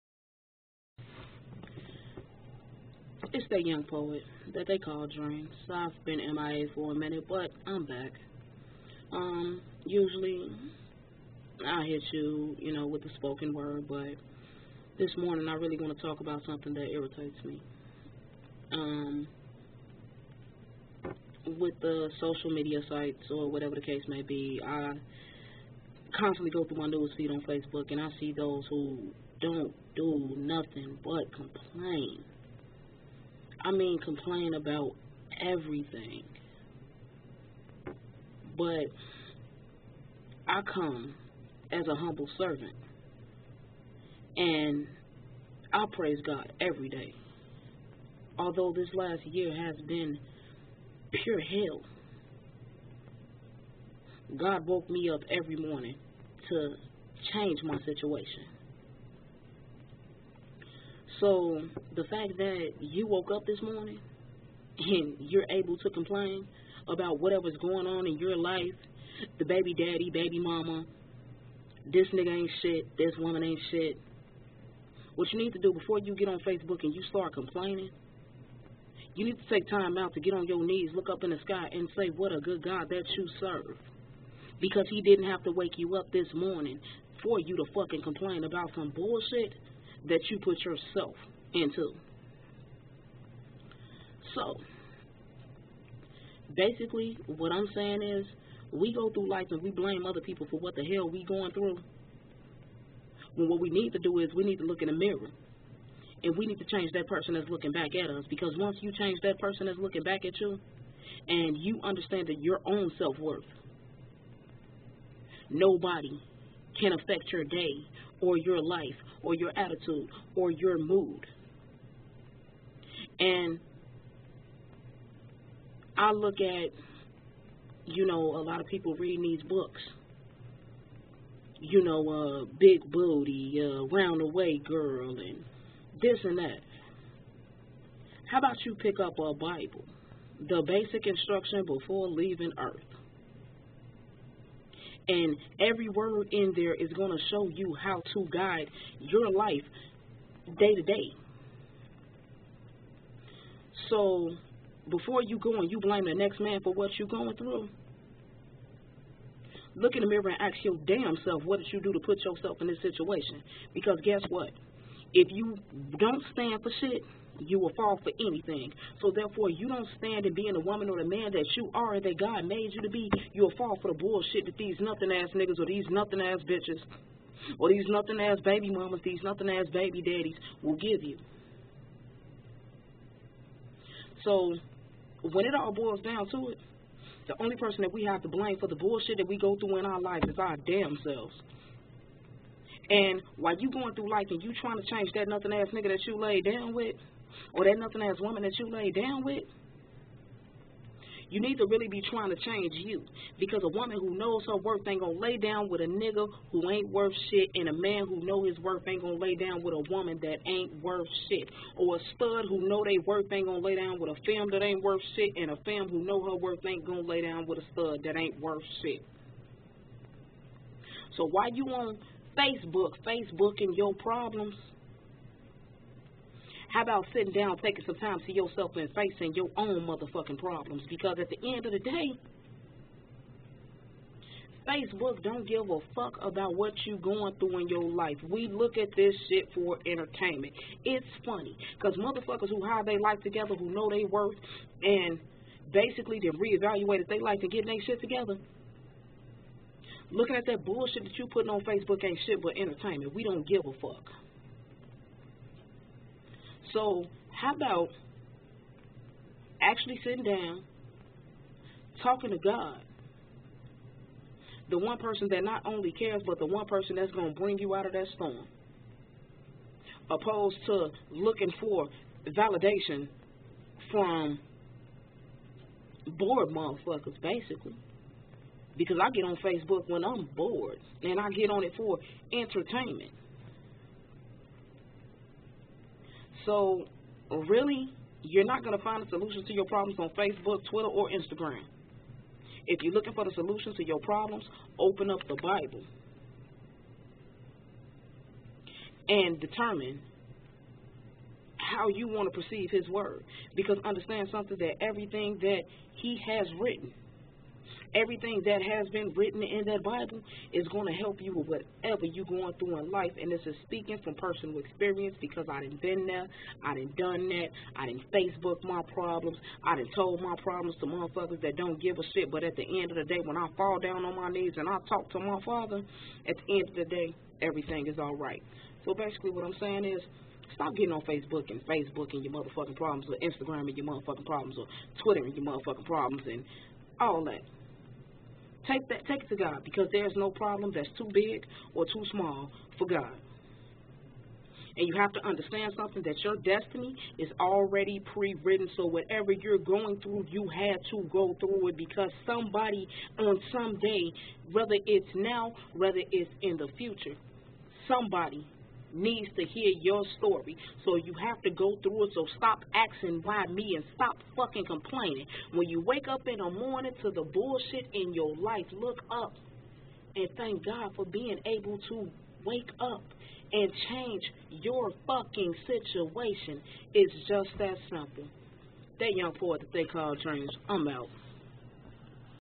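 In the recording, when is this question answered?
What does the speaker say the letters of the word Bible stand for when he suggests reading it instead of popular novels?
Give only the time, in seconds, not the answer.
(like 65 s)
140 s.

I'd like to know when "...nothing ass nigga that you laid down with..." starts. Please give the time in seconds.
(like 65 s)
195 s.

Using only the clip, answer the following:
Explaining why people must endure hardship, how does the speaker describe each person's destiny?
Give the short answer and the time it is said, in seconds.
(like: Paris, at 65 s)
already pre written, at 347 s.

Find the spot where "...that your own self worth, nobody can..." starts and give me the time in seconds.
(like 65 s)
112 s.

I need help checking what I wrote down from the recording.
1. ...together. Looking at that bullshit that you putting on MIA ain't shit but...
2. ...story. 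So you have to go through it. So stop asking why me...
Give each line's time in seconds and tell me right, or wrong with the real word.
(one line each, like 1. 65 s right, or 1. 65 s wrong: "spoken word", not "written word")
1. 247 s wrong: "Facebook", not "MIA"
2. 360 s right.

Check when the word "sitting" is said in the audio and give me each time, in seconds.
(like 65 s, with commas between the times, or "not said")
227 s, 260 s.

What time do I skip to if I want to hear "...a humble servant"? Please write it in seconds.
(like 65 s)
41 s.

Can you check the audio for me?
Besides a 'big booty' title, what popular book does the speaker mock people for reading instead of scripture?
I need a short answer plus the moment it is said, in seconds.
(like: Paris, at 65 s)
round the way girl, at 133 s.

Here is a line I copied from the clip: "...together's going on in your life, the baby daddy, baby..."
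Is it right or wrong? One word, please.
wrong.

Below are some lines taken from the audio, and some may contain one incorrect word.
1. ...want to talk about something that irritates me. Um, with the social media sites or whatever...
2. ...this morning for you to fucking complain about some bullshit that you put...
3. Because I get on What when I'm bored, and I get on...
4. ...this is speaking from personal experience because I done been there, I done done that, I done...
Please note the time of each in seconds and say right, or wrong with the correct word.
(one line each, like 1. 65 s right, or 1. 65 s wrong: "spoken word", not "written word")
1. 15 s right
2. 86 s right
3. 278 s wrong: "Facebook", not "What"
4. 313 s right.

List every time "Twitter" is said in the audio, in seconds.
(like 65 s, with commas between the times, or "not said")
290 s, 335 s.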